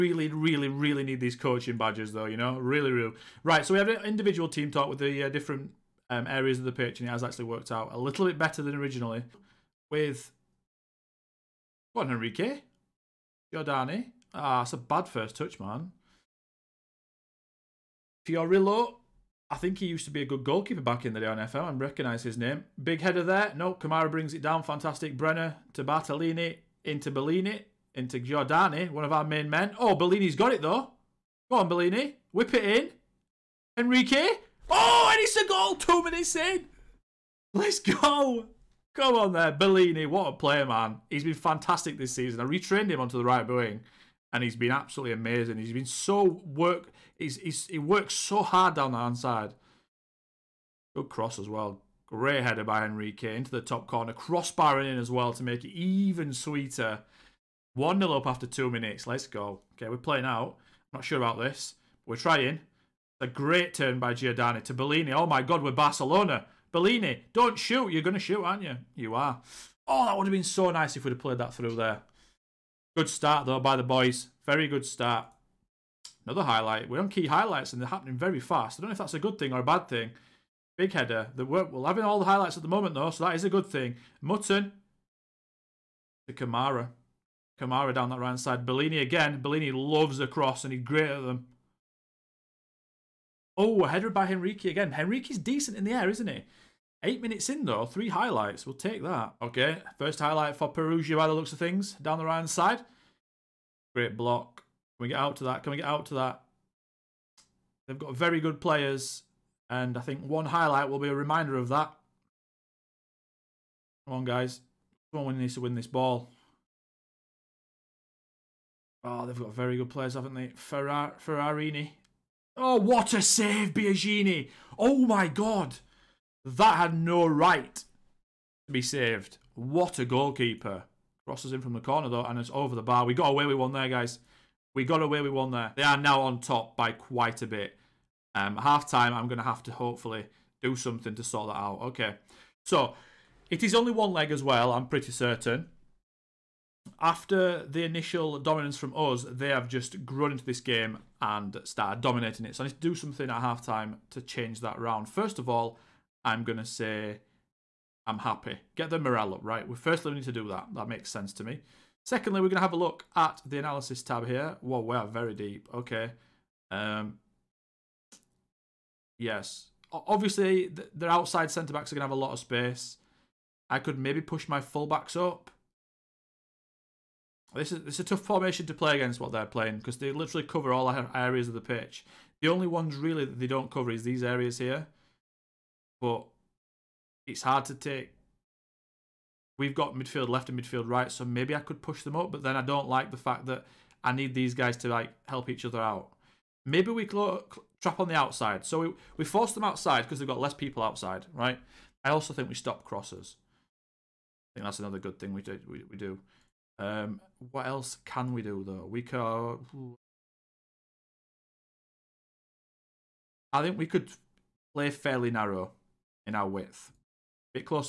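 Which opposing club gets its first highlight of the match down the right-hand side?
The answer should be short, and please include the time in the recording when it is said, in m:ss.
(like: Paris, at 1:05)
Perugia, at 1:40.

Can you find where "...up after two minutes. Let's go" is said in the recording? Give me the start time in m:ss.
0:58.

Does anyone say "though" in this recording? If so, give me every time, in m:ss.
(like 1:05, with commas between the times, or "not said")
0:02, 0:30, 1:13, 1:22, 1:37, 2:12, 3:28.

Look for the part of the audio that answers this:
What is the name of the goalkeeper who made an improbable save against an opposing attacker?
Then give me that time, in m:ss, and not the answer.
2:03.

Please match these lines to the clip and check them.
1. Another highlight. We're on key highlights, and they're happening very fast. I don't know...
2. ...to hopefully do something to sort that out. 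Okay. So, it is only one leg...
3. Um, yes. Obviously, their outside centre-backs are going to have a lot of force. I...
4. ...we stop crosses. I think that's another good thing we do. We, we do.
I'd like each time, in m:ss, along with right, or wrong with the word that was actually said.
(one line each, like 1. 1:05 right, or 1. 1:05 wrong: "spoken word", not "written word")
1. 1:16 right
2. 2:19 right
3. 2:46 wrong: "space", not "force"
4. 3:22 right.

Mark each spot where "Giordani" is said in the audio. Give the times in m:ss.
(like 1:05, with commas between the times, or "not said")
0:13, 0:28, 1:04.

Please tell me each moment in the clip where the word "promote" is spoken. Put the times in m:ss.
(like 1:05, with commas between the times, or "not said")
not said.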